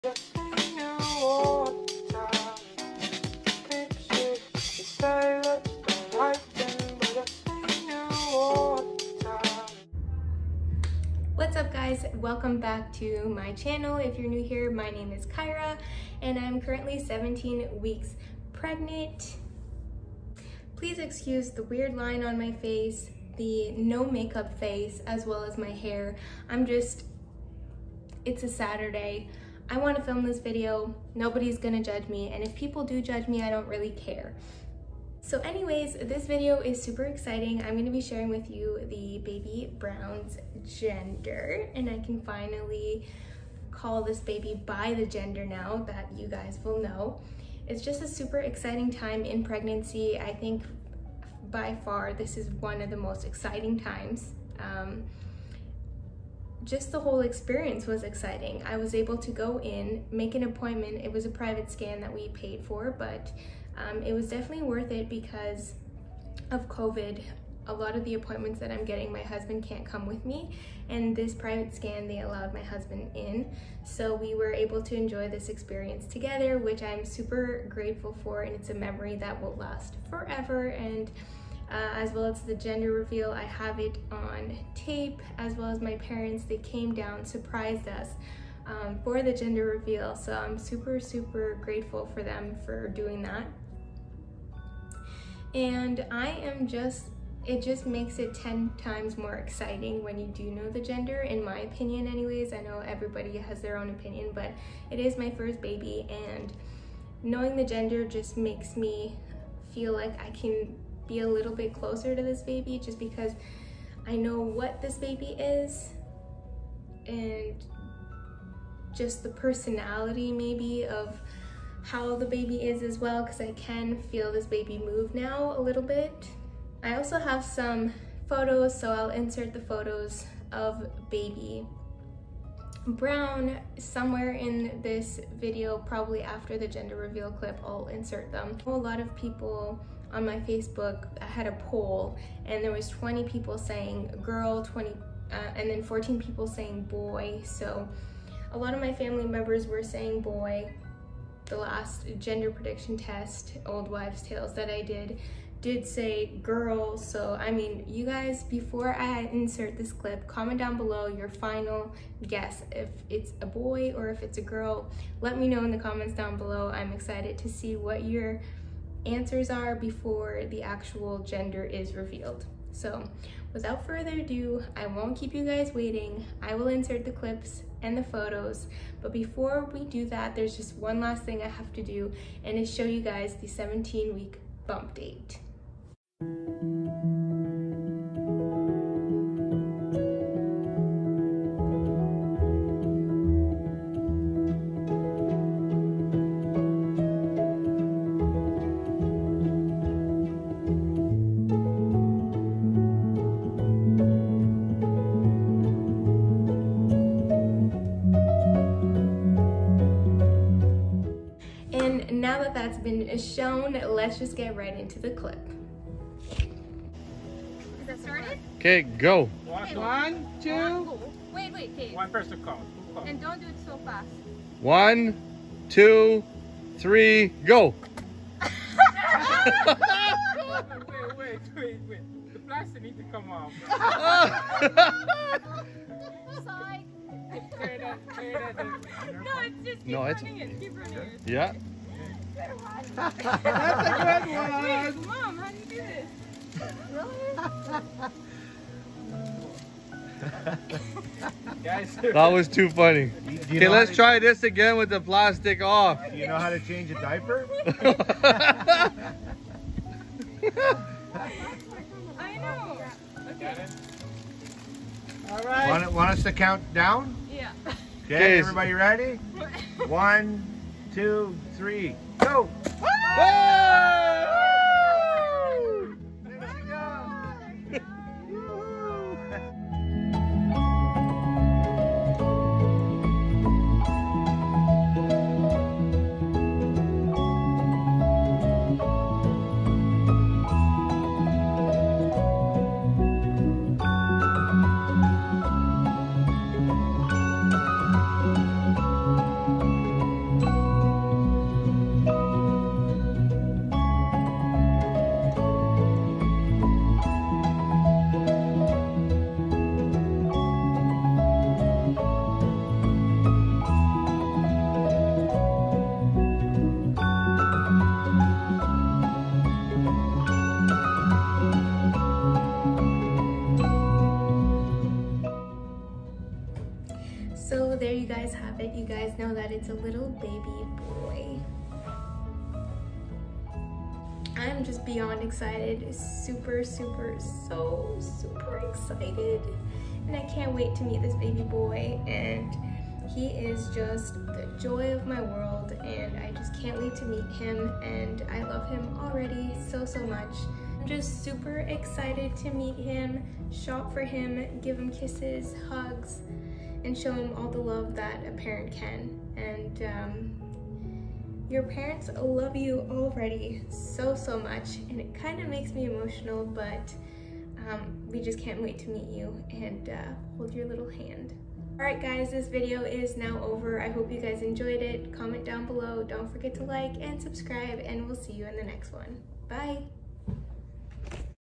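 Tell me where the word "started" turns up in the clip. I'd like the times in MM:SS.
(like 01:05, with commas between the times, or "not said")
03:38.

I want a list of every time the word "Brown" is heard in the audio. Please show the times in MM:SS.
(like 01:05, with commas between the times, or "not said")
00:39, 02:12.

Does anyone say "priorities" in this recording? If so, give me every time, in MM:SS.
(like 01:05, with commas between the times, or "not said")
not said.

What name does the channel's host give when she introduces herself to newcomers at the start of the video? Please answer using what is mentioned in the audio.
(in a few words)
Kyraa.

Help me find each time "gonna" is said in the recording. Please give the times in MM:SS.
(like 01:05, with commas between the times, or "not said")
00:31, 00:37.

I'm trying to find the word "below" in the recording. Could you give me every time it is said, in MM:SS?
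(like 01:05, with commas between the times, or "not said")
02:40, 02:46, 06:15.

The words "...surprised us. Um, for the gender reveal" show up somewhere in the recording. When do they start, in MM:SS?
01:27.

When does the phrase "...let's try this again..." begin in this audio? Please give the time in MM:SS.
04:13.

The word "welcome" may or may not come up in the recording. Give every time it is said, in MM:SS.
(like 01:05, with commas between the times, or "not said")
00:12.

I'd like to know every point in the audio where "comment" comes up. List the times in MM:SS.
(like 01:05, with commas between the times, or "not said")
02:40, 02:45, 06:15.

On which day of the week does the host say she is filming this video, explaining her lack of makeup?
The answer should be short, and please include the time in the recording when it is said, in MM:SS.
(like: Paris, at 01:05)
Saturday, at 00:28.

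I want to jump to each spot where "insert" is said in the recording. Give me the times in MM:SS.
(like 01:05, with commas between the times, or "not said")
02:09, 02:17, 02:39, 02:56.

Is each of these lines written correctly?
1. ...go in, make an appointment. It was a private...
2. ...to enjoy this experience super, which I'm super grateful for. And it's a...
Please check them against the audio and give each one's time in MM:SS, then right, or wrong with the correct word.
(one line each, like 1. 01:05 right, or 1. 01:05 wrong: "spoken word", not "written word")
1. 00:59 right
2. 01:14 wrong: "together", not "super".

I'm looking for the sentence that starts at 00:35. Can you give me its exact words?
So anyways, this video is super exciting.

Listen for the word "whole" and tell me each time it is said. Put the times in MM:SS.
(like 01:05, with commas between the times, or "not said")
00:56.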